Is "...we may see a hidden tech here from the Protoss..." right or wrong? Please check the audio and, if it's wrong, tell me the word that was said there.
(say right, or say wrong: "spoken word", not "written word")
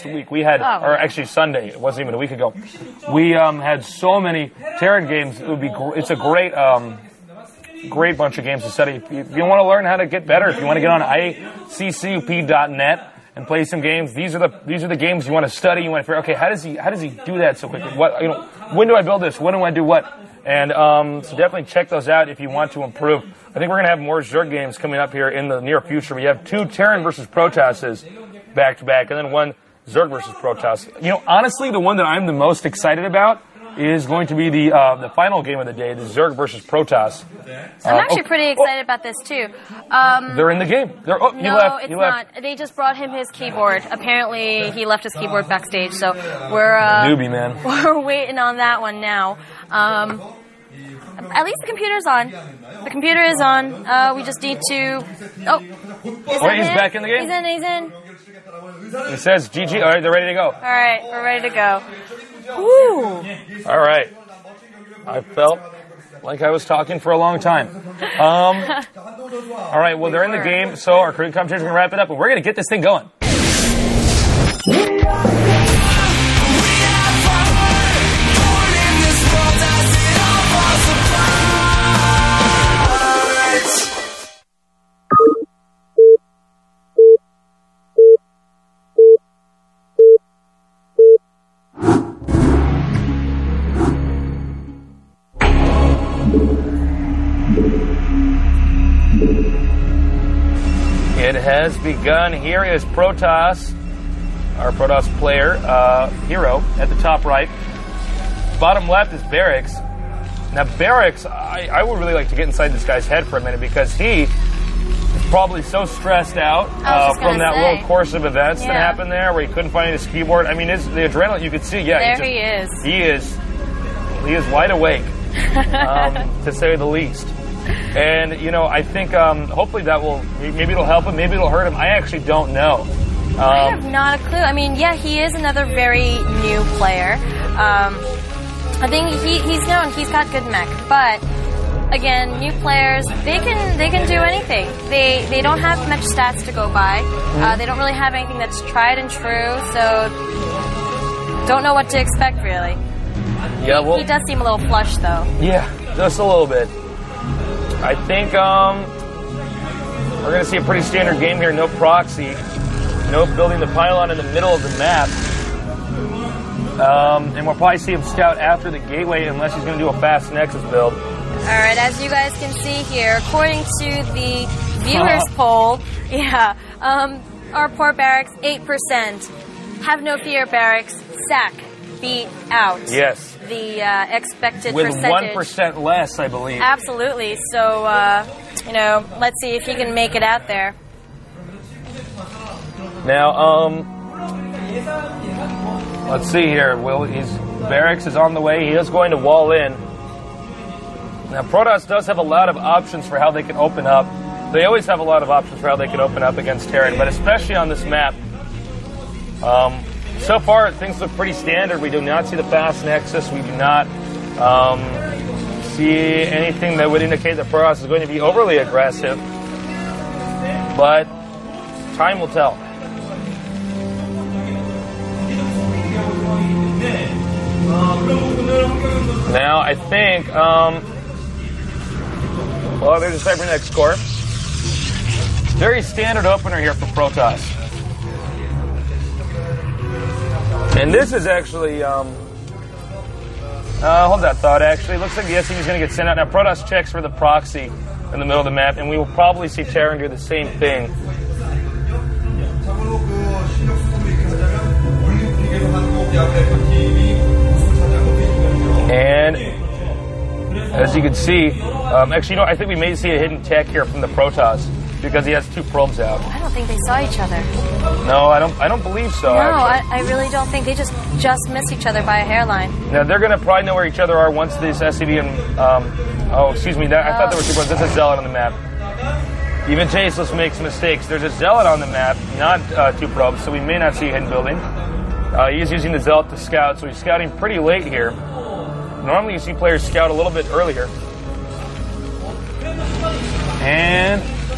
right.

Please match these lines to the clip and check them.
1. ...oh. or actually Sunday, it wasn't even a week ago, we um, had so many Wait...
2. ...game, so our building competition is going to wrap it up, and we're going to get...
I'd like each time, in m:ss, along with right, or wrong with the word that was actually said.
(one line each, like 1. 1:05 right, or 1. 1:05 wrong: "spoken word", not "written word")
1. 0:00 wrong: "Terran", not "Wait"
2. 1:10 wrong: "cooking", not "building".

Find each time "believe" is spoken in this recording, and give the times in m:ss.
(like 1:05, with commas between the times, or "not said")
3:06, 4:28.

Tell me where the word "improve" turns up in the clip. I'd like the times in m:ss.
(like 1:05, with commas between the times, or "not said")
0:22.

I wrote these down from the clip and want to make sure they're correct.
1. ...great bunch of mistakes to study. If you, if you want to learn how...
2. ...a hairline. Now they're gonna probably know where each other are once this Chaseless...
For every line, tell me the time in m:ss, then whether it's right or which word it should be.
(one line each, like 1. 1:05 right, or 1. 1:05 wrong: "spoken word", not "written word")
1. 0:07 wrong: "games", not "mistakes"
2. 4:32 wrong: "SCV", not "Chaseless".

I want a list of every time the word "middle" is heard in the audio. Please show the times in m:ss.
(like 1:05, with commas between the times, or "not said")
2:44, 4:08.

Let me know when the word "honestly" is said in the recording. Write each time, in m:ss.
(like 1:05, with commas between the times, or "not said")
0:31.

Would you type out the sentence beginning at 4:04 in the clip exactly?
Looks like the SCV is going to get sent out.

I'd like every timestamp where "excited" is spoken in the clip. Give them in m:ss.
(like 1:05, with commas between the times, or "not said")
0:32, 0:38.